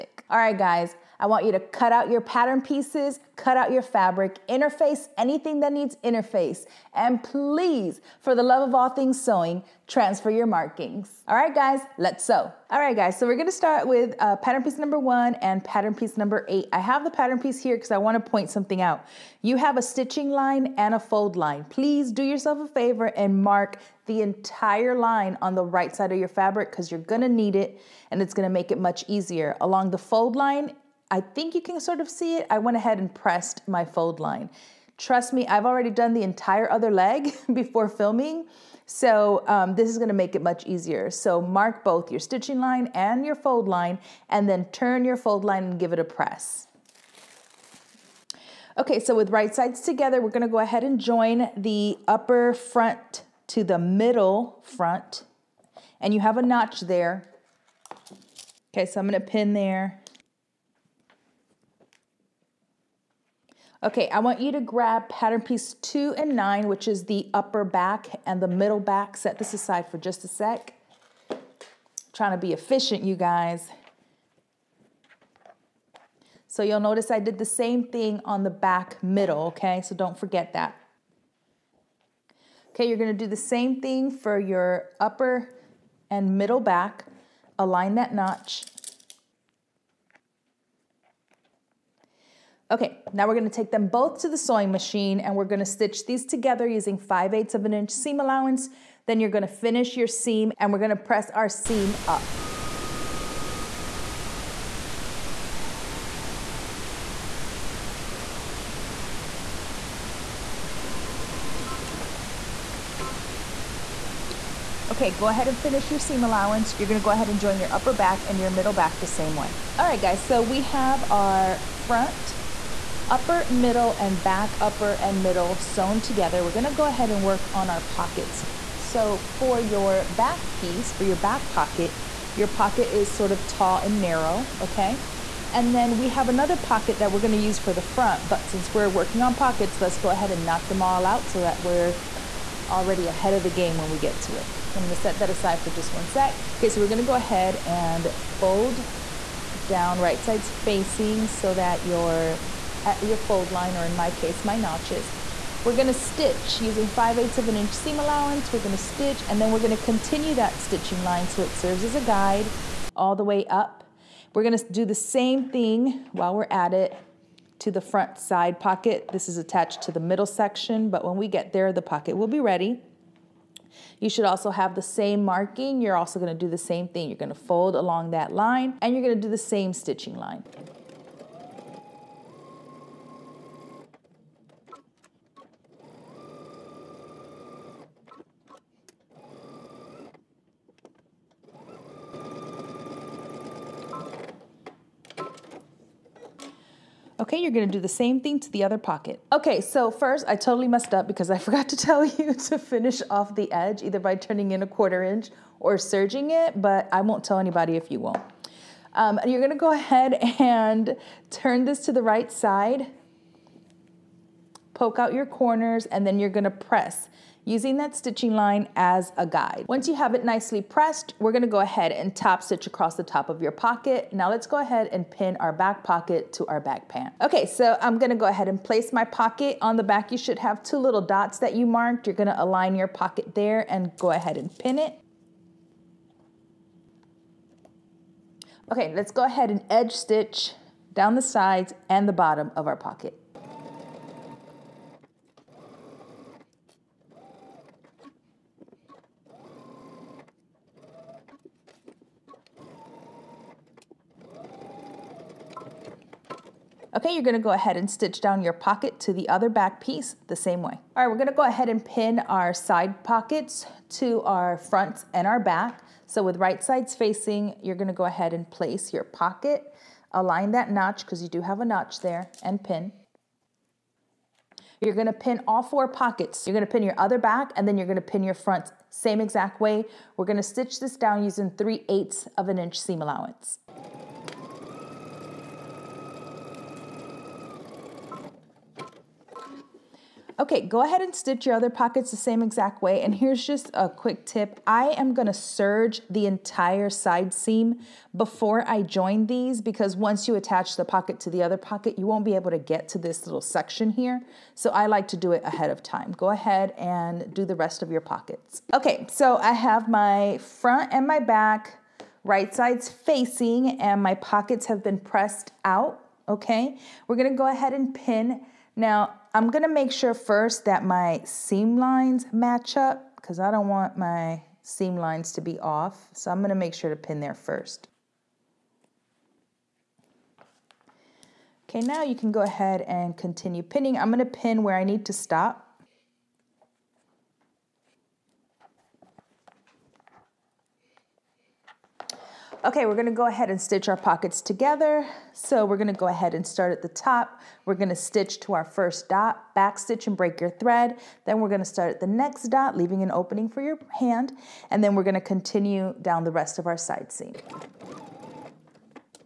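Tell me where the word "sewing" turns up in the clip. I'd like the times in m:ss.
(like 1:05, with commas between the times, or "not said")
0:09, 1:34.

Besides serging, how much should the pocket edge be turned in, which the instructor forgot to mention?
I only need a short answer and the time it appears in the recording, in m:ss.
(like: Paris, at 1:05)
1/4 inch, at 3:24.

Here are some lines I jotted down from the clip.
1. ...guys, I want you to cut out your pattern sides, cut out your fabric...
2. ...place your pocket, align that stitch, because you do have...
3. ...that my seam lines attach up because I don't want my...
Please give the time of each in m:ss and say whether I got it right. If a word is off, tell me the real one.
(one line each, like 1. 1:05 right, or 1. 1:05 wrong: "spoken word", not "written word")
1. 0:00 wrong: "pieces", not "sides"
2. 4:28 wrong: "notch", not "stitch"
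3. 5:20 wrong: "match", not "attach".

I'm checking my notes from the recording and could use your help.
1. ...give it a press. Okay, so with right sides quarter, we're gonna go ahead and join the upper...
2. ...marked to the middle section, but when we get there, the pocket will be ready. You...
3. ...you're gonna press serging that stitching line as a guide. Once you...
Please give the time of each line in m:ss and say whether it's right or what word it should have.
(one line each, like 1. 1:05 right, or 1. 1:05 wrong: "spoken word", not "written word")
1. 0:45 wrong: "together", not "quarter"
2. 2:49 wrong: "attached", not "marked"
3. 3:36 wrong: "using", not "serging".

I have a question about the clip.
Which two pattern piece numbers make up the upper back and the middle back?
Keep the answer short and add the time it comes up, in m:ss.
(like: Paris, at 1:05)
2 and 9, at 1:05.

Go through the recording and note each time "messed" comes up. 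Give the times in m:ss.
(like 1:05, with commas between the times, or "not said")
3:20.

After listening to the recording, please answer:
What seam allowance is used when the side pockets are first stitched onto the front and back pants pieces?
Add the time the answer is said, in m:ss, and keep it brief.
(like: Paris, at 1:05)
3/8 inch, at 4:41.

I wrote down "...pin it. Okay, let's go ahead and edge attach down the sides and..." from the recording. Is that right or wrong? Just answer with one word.
wrong.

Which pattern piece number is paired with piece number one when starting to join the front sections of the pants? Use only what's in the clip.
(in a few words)
8.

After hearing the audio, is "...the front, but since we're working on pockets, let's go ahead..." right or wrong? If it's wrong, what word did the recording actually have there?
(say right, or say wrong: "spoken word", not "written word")
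right.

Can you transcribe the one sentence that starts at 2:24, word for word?
I'm gonna set that aside for just one sec.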